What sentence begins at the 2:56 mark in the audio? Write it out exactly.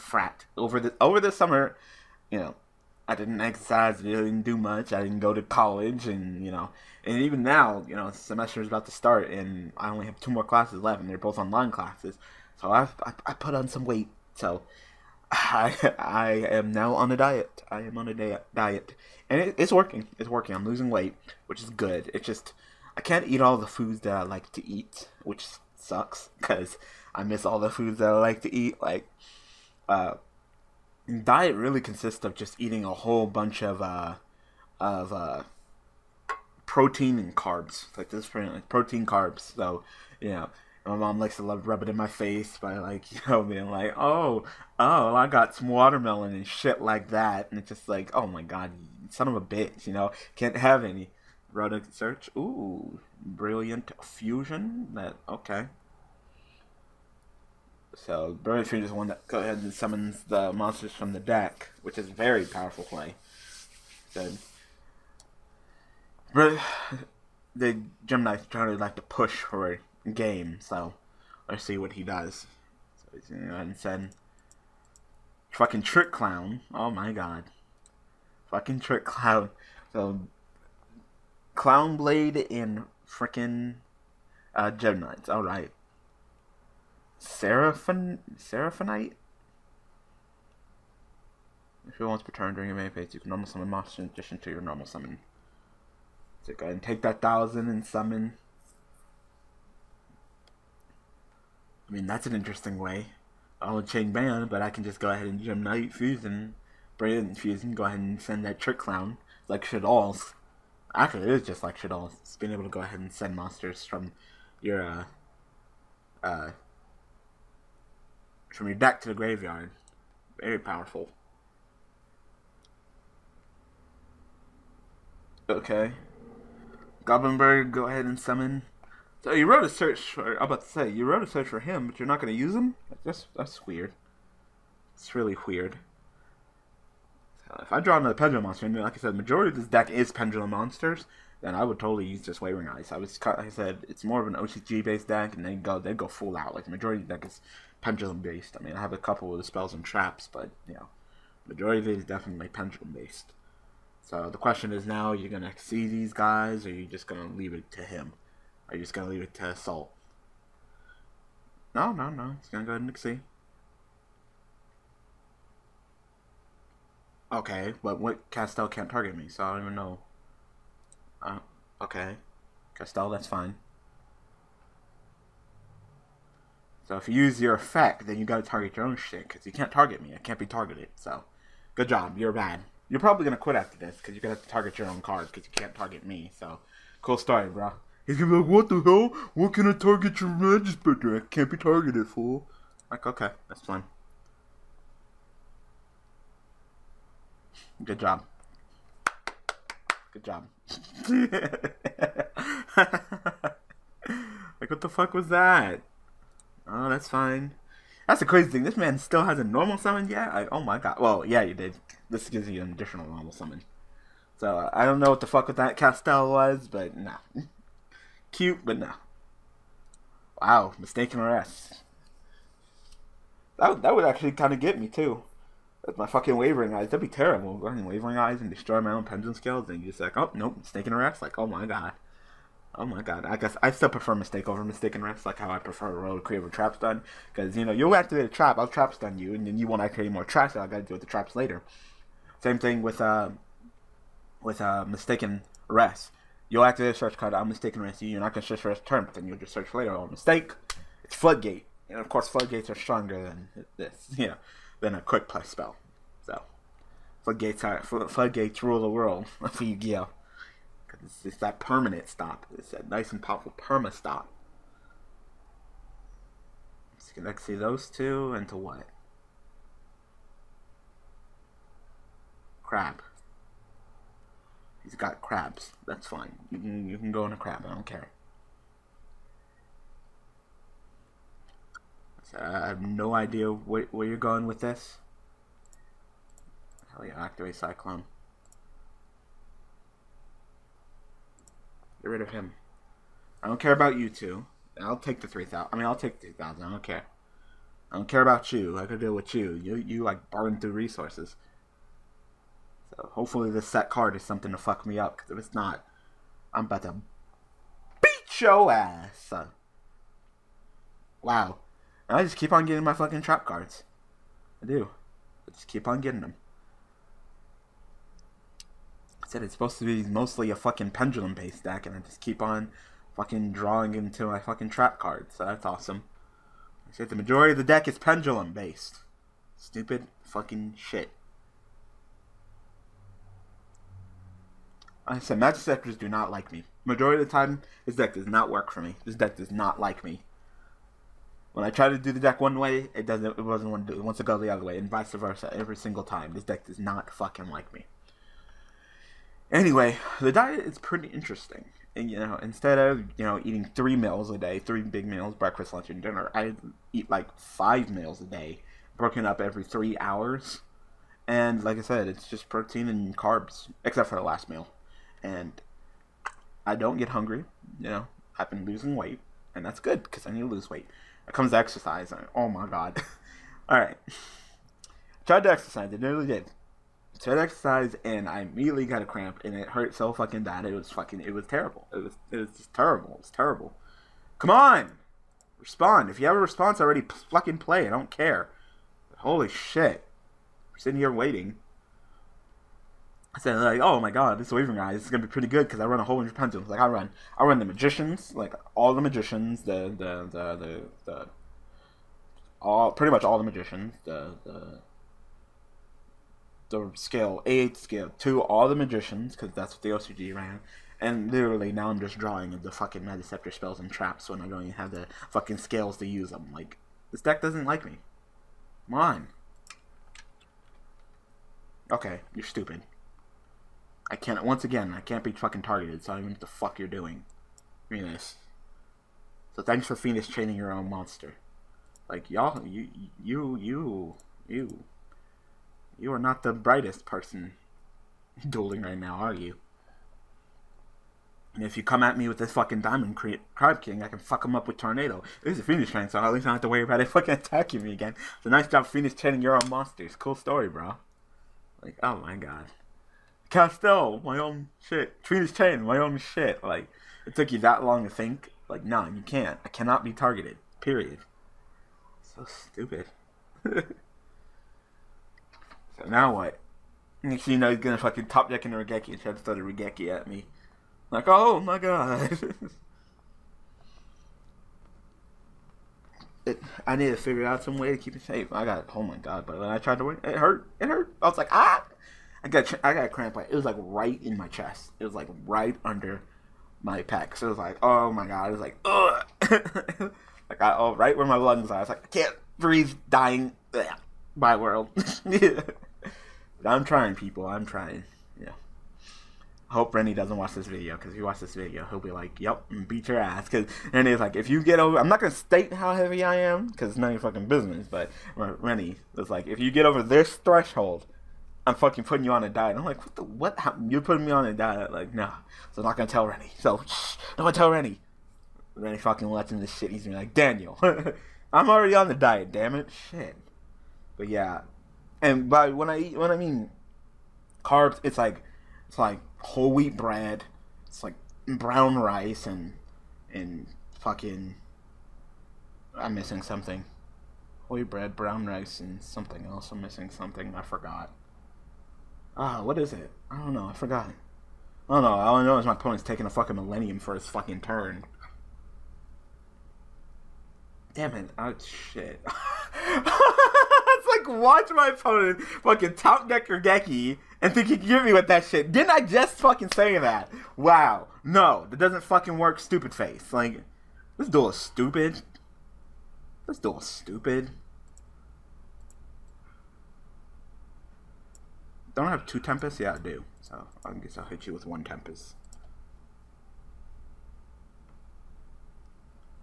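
So if you use your effect, then you gotta target your own shit, because you can't target me.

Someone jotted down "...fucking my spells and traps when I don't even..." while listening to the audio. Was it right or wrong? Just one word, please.
right.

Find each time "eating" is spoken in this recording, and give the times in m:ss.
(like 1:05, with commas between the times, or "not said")
0:32, 5:53.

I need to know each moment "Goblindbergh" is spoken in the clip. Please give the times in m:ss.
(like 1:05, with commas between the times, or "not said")
2:07.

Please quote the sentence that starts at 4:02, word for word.
Same thing with uh, with uh, mistaken arrest.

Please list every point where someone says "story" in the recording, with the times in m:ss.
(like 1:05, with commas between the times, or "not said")
3:07, 7:30.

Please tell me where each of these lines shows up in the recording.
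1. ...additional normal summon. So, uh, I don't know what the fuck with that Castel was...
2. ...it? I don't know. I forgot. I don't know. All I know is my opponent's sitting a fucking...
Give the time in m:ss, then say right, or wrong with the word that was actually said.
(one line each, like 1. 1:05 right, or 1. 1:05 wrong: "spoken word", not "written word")
1. 3:32 right
2. 9:02 wrong: "taking", not "sitting".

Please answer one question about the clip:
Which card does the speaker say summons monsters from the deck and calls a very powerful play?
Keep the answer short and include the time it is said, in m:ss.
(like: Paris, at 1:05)
Burning Stream, at 0:58.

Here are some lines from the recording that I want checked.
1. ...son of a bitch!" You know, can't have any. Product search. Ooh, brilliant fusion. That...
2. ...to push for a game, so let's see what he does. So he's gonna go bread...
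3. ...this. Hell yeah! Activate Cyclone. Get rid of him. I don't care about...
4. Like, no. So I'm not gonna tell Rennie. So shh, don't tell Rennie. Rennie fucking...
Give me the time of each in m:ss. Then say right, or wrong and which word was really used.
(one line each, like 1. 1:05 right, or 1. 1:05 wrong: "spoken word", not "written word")
1. 0:49 right
2. 1:08 wrong: "ahead", not "bread"
3. 4:44 right
4. 8:34 right.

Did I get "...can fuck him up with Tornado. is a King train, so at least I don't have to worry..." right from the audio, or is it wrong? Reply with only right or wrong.
wrong.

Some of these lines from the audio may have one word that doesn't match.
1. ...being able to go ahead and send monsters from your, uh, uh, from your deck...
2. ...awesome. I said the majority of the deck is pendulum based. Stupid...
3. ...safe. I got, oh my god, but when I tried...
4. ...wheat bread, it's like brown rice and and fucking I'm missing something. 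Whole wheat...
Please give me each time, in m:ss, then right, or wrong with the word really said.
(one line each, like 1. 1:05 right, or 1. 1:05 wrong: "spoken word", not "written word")
1. 1:52 right
2. 5:25 right
3. 7:58 right
4. 8:49 right.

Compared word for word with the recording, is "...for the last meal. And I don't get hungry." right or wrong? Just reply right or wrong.
right.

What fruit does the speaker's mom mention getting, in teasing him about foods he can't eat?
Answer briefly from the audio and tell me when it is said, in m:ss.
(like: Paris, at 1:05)
Watermelon, at 0:45.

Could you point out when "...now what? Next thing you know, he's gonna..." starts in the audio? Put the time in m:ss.
7:46.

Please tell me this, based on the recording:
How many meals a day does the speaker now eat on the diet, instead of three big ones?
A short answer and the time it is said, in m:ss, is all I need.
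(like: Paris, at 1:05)
5, at 5:57.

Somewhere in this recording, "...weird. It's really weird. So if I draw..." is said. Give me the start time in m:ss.
2:13.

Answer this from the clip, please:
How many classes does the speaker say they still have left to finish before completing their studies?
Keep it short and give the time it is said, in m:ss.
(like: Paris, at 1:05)
2, at 0:10.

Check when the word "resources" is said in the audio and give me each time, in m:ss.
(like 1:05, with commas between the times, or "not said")
5:00.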